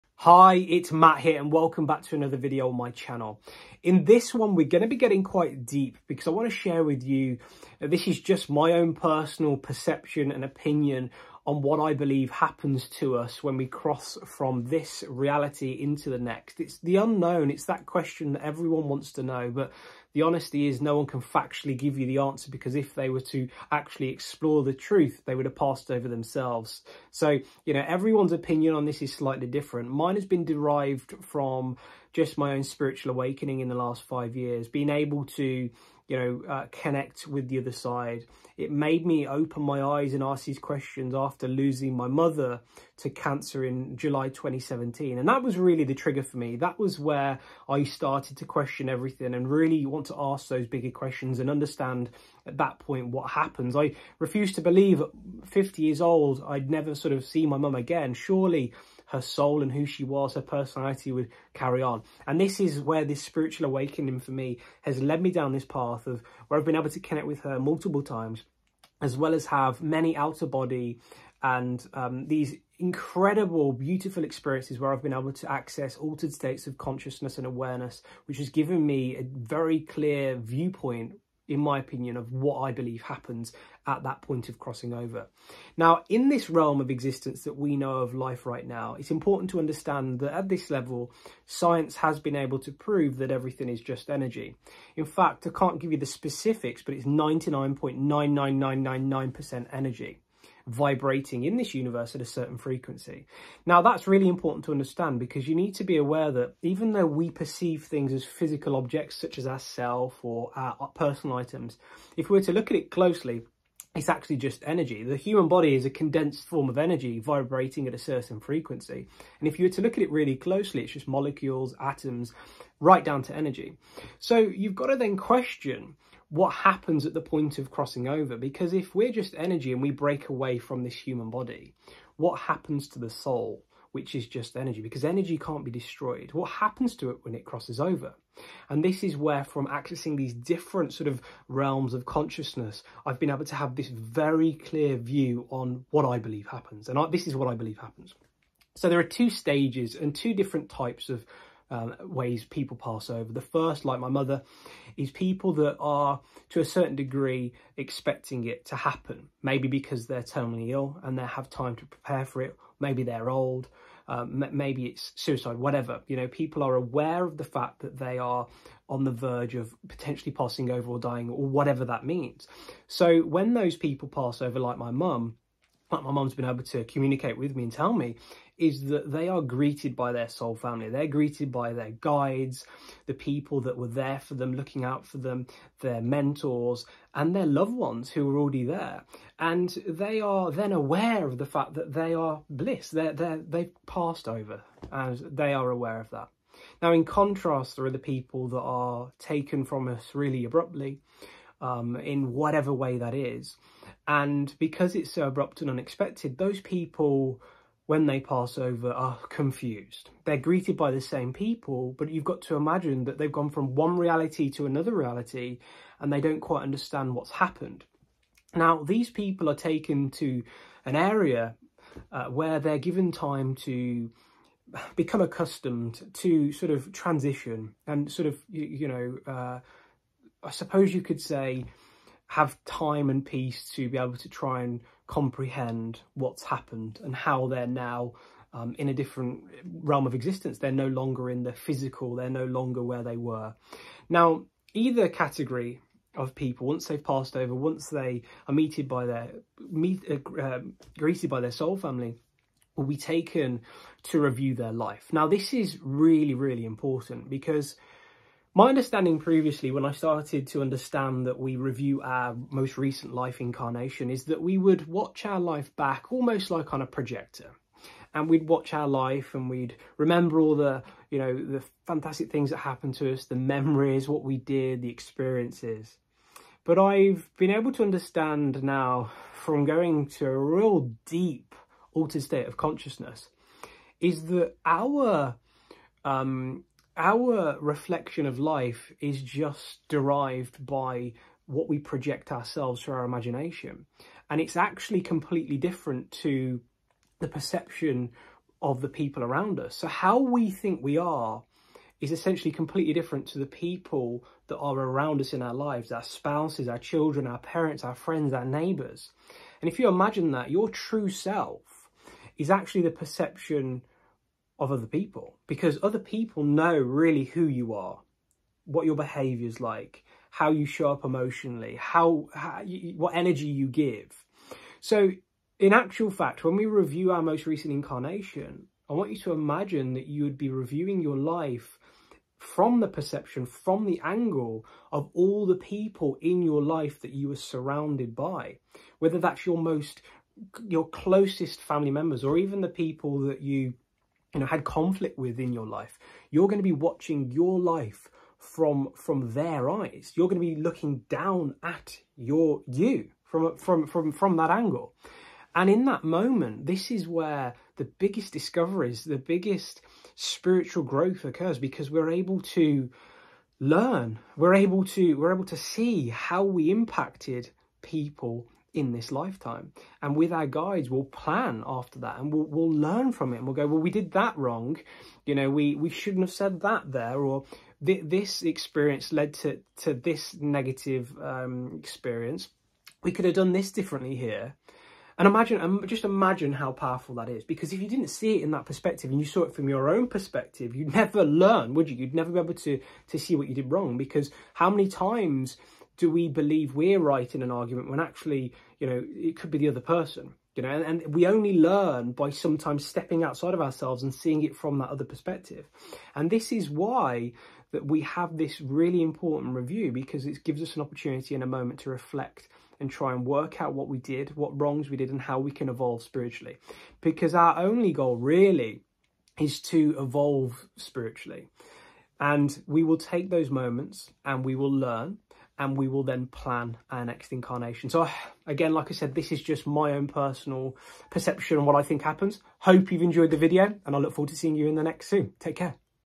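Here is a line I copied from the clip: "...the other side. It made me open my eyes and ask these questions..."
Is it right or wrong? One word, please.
right.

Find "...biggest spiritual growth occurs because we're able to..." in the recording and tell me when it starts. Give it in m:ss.
5:59.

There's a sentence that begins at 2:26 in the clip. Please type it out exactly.
And I, this is what I believe happens.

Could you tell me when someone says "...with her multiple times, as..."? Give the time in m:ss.
1:07.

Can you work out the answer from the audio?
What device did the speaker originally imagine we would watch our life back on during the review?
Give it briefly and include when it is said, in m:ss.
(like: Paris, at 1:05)
a projector, at 4:26.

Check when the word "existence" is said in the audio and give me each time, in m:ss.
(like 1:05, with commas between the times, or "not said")
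1:26, 4:00.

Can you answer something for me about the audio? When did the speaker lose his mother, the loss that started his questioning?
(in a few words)
July 2017.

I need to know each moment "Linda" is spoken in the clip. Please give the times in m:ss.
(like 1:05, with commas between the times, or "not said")
not said.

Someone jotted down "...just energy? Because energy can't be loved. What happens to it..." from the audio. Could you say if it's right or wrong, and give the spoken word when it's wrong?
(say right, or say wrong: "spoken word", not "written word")
wrong: "destroyed", not "loved".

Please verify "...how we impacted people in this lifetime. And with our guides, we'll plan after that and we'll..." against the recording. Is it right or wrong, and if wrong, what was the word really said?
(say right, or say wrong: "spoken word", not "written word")
right.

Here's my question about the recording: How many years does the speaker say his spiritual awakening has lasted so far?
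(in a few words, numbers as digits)
5.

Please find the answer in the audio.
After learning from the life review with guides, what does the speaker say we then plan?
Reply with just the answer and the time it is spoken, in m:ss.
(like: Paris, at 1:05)
our next incarnation, at 7:06.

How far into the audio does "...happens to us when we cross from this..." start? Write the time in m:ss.
0:12.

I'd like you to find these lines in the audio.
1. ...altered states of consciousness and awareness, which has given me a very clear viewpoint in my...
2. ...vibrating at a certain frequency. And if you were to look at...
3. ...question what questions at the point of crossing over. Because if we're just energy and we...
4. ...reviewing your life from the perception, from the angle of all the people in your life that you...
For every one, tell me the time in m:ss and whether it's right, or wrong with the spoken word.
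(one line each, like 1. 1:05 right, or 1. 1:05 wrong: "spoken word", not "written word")
1. 1:15 right
2. 1:57 right
3. 2:05 wrong: "happens", not "questions"
4. 5:30 right.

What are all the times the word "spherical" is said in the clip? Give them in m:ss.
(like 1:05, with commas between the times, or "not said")
not said.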